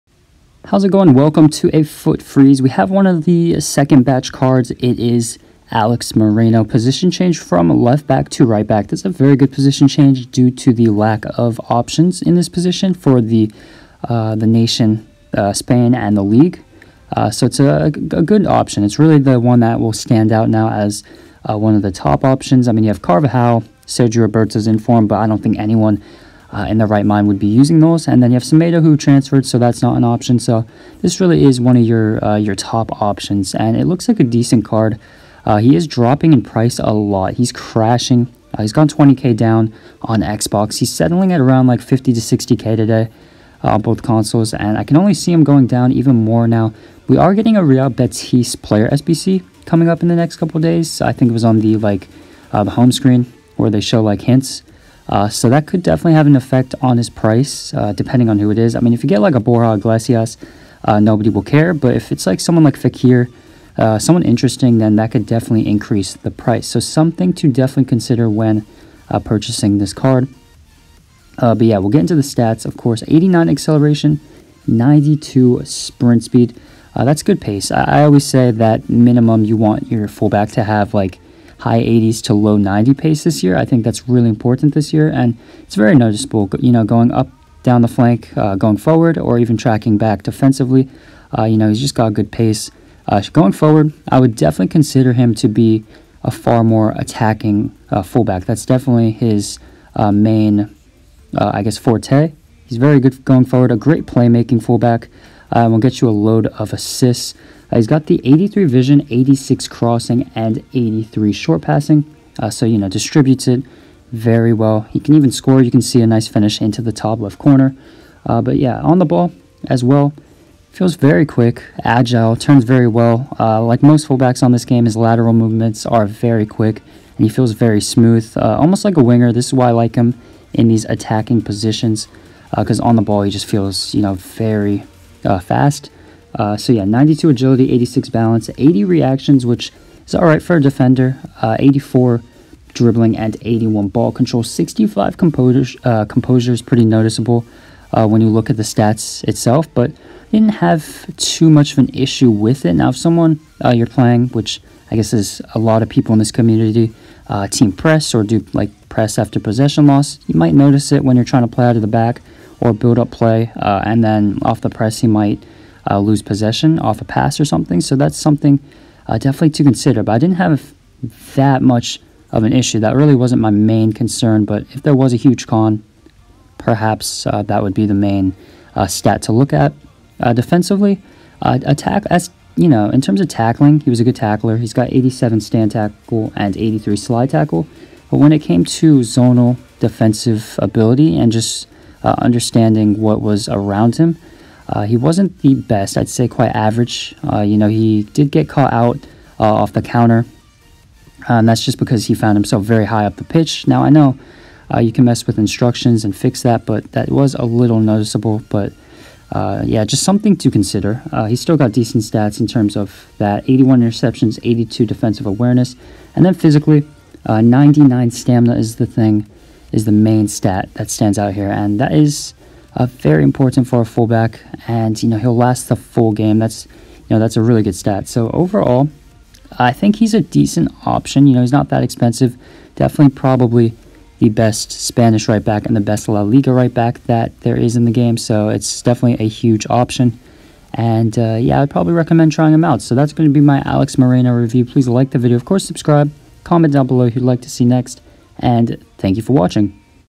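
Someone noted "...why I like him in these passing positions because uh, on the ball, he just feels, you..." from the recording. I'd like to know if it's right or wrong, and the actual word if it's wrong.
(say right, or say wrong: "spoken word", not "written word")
wrong: "attacking", not "passing".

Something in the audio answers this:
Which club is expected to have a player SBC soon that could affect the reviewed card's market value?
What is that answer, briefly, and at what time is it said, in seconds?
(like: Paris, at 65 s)
Real Betis, at 47 s.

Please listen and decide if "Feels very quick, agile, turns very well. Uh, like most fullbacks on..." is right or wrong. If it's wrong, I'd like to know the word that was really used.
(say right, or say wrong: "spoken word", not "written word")
right.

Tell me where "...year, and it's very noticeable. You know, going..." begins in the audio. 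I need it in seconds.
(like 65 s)
84 s.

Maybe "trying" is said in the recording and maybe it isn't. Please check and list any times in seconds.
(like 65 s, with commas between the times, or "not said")
161 s, 242 s.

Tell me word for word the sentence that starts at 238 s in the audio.
So it's definitely a huge option.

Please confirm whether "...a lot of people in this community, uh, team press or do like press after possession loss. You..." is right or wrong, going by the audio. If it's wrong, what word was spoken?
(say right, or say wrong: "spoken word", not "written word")
right.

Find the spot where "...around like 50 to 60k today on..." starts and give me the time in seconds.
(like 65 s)
41 s.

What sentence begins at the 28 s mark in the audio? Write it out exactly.
And then you have Semedo who transferred, so that's not an option.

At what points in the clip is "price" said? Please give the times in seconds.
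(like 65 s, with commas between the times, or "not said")
36 s, 57 s, 66 s.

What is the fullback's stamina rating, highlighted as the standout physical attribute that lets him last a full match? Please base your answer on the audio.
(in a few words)
99.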